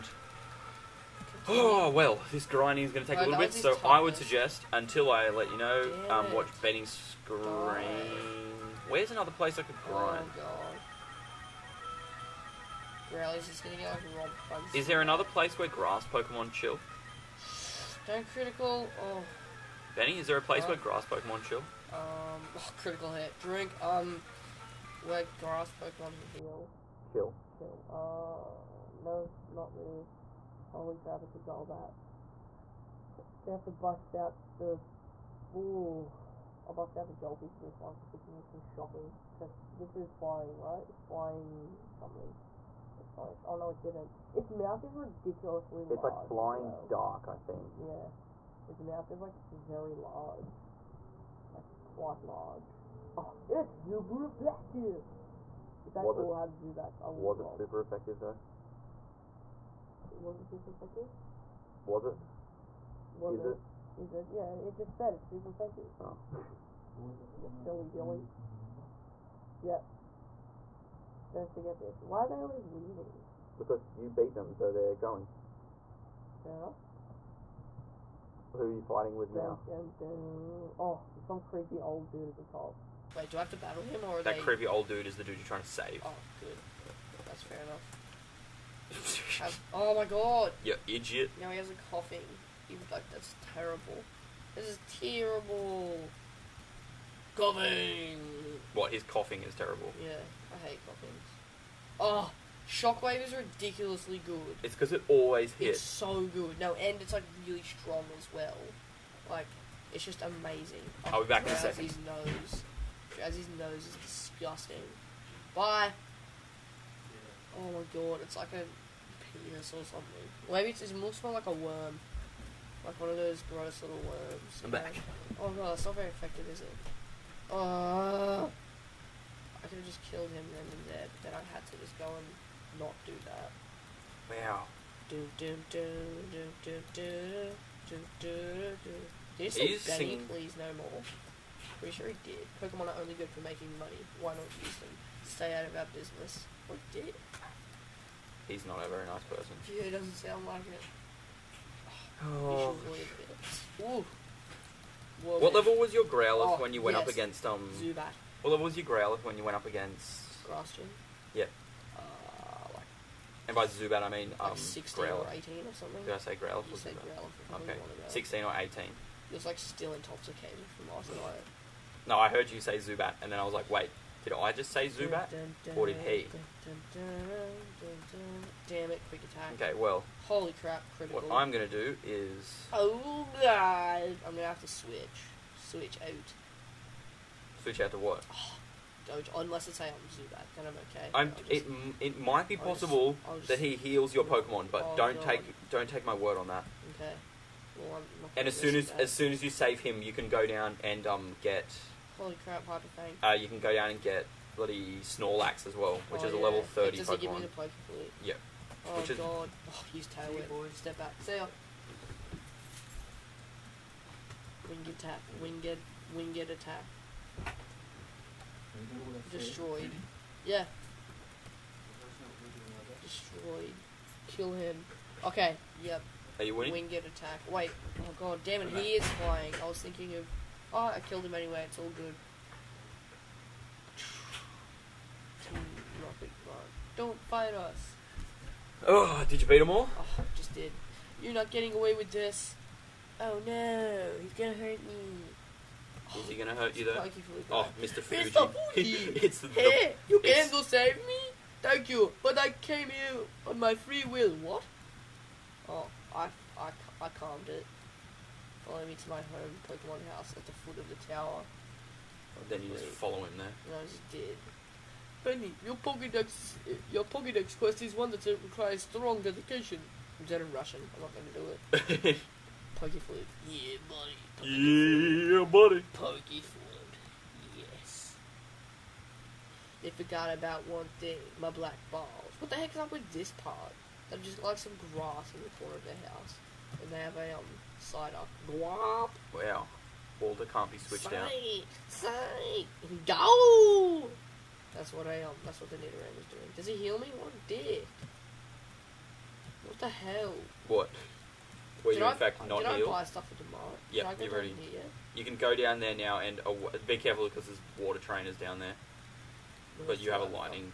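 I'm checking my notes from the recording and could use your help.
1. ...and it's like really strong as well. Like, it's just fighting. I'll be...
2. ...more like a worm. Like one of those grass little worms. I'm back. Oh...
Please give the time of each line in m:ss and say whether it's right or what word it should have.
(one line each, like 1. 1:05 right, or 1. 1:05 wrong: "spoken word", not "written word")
1. 1:46 wrong: "amazing", not "fighting"
2. 2:01 wrong: "gross", not "grass".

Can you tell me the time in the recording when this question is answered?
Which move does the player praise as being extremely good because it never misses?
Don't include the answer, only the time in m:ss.
1:42.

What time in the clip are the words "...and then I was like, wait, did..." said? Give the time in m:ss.
2:53.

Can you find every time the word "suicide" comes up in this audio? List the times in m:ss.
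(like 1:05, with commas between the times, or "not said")
not said.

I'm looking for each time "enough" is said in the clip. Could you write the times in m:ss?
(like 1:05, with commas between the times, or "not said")
1:16, 1:27.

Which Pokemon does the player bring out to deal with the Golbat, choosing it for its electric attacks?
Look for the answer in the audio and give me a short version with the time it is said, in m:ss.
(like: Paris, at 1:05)
Jolty, at 0:37.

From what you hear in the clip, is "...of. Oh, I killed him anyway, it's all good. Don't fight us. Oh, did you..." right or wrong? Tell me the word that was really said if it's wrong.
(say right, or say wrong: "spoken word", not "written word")
right.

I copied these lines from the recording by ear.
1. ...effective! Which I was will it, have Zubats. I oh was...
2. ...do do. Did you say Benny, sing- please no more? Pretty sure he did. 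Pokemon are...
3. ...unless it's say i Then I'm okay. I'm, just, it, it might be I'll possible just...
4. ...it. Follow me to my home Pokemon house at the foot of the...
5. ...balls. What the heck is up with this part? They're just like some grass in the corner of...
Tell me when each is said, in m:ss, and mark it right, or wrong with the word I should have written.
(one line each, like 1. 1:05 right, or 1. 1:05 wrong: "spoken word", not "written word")
1. 0:54 right
2. 2:18 right
3. 3:09 right
4. 4:17 right
5. 4:41 right.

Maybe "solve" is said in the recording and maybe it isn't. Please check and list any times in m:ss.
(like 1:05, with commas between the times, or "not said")
not said.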